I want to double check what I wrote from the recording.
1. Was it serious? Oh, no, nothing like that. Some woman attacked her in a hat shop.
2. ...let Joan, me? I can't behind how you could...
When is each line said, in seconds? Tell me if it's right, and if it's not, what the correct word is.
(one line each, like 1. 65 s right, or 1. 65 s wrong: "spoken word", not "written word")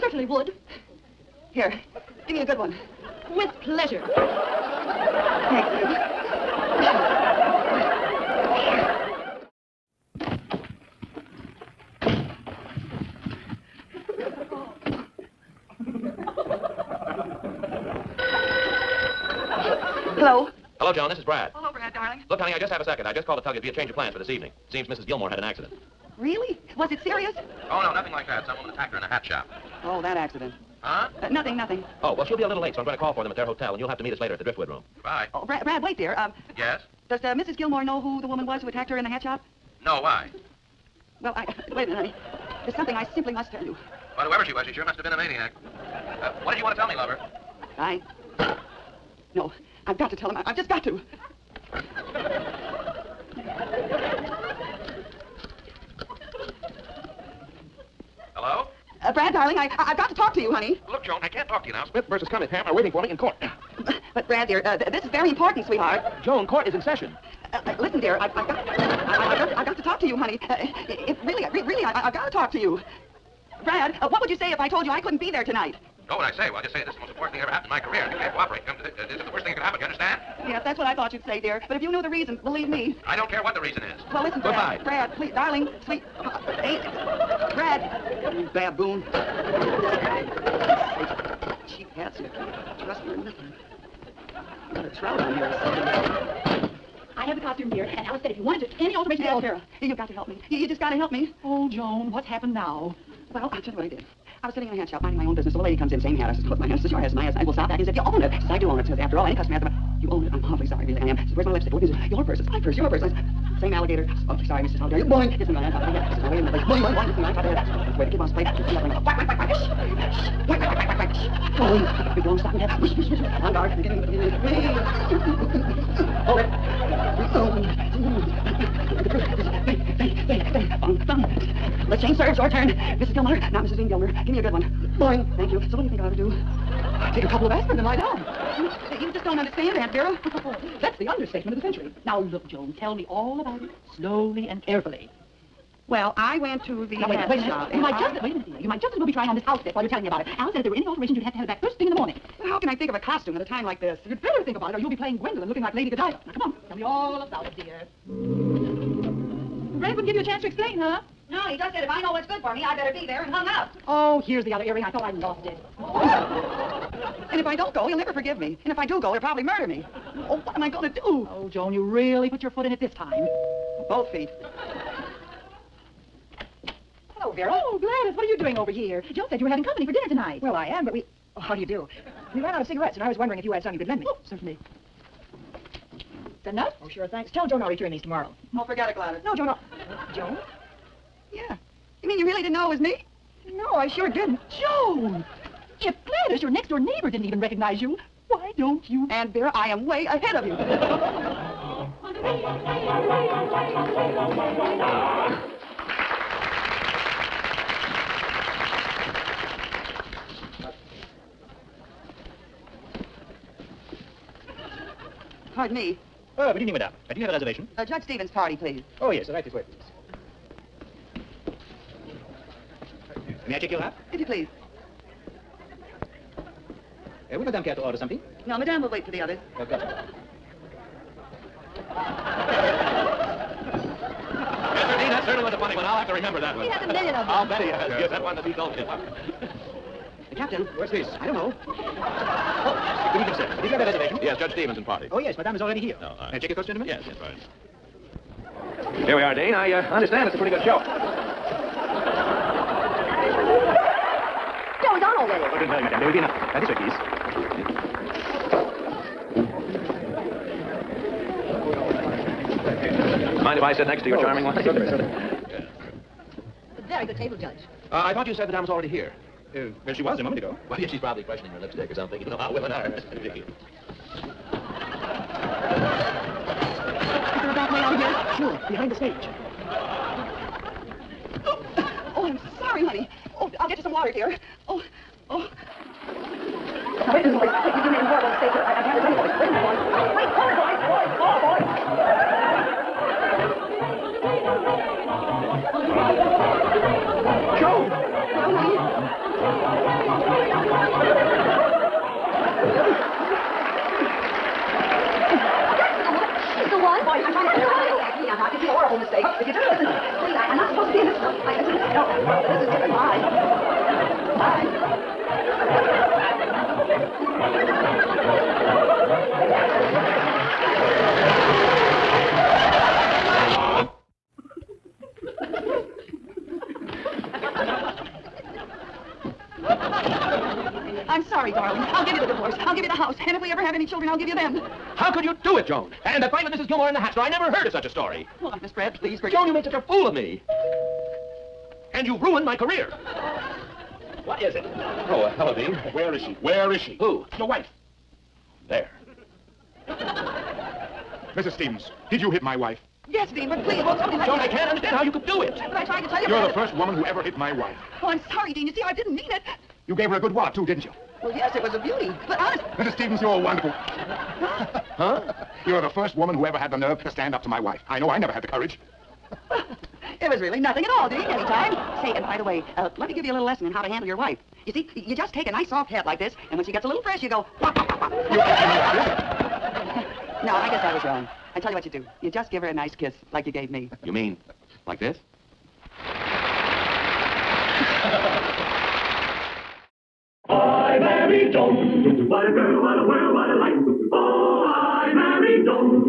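1. 26 s right
2. 354 s wrong: "understand", not "behind".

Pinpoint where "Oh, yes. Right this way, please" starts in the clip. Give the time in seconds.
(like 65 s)
219 s.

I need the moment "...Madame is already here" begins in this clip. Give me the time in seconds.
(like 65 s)
245 s.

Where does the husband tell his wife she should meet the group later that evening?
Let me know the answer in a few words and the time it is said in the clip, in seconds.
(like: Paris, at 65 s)
Driftwood Room, at 34 s.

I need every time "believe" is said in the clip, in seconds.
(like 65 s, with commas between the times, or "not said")
82 s.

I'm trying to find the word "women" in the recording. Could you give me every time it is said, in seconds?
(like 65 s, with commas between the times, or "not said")
272 s.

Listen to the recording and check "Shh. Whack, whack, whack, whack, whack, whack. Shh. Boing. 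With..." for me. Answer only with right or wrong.
right.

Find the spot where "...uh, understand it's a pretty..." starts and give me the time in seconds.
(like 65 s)
249 s.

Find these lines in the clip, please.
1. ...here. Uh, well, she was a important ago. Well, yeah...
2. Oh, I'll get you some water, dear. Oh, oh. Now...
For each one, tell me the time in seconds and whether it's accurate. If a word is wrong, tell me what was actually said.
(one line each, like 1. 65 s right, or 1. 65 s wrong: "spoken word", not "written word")
1. 268 s wrong: "moment", not "important"
2. 283 s right.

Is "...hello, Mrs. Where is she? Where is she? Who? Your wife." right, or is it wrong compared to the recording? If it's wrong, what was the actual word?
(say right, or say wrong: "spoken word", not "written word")
wrong: "Dean", not "Mrs".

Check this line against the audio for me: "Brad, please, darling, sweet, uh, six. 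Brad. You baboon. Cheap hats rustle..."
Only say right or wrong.
wrong.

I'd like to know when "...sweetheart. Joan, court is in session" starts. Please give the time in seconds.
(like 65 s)
65 s.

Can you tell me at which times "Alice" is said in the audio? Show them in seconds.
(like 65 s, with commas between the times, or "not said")
98 s, 150 s.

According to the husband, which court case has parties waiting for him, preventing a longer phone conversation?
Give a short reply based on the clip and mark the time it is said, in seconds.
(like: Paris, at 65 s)
Smith versus Cunningham, at 61 s.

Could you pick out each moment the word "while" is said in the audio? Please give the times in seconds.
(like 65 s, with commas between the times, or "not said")
149 s.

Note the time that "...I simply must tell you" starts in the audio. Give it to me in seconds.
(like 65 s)
42 s.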